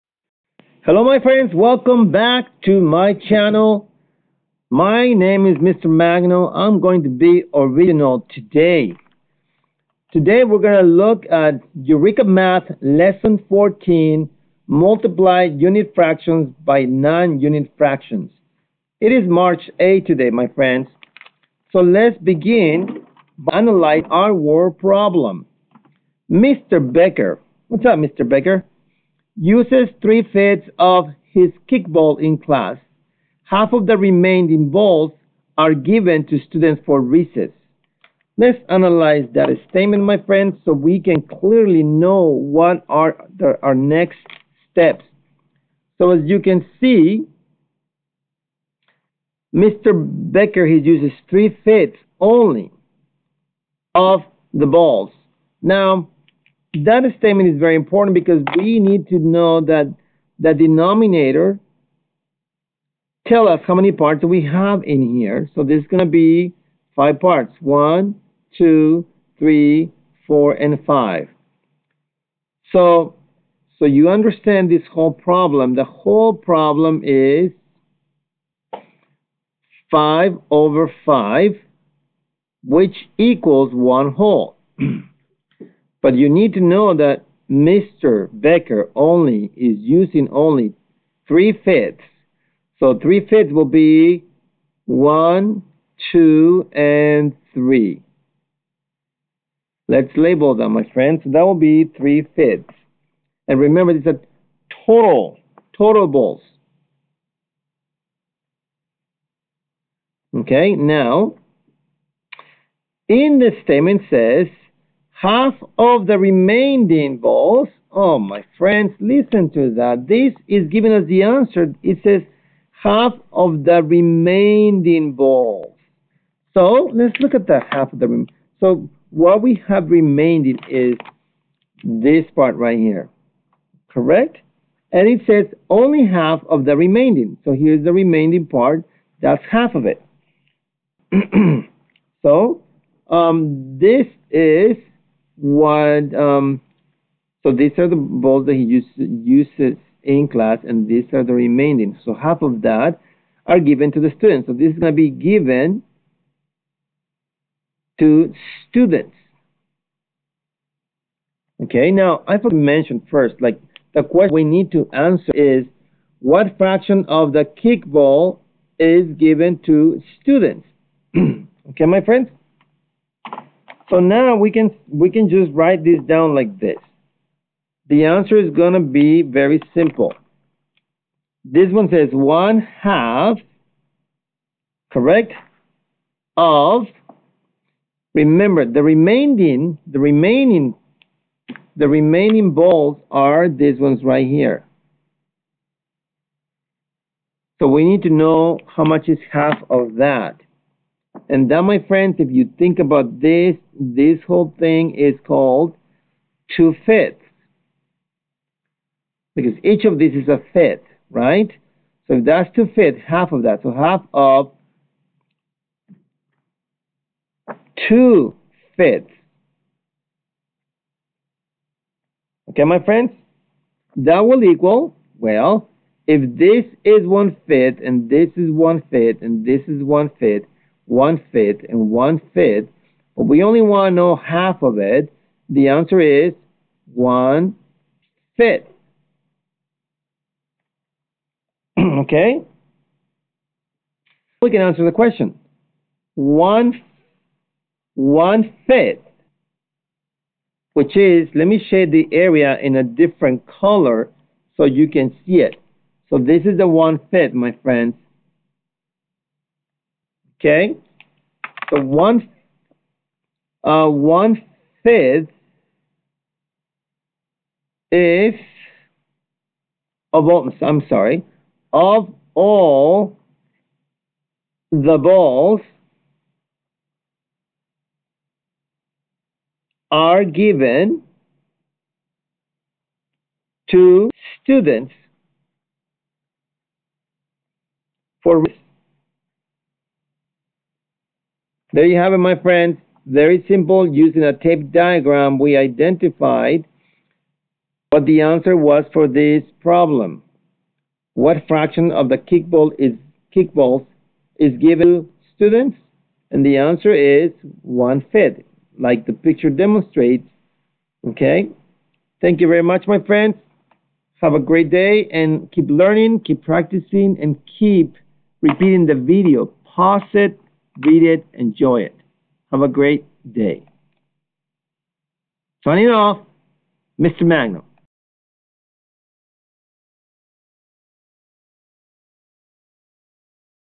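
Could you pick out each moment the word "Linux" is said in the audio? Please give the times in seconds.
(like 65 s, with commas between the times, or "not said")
not said.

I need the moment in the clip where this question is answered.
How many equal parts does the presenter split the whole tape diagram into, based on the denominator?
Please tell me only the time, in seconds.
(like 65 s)
66 s.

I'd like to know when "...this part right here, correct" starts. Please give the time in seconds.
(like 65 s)
131 s.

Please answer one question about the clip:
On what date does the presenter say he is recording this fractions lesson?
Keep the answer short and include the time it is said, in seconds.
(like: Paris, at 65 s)
March 8, at 19 s.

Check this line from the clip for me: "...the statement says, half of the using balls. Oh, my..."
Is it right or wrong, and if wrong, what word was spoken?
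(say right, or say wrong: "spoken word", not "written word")
wrong: "remaining", not "using".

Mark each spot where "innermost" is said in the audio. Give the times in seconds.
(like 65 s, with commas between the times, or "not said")
not said.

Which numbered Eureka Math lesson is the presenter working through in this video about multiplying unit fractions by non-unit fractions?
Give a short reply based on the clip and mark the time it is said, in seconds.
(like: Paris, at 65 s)
Lesson 14, at 12 s.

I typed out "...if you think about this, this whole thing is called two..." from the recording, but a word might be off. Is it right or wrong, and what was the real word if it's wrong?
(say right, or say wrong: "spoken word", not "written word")
right.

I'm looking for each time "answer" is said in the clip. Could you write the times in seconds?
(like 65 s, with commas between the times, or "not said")
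121 s, 164 s, 178 s, 235 s, 244 s, 298 s, 306 s.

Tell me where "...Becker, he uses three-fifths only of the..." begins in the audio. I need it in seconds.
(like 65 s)
49 s.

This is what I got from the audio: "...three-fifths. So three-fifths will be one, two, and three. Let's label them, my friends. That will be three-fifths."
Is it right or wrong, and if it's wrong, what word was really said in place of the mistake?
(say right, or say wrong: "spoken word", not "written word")
right.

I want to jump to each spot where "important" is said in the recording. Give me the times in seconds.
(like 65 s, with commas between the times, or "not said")
57 s.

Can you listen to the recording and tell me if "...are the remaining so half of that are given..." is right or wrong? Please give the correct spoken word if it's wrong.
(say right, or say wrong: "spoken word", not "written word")
right.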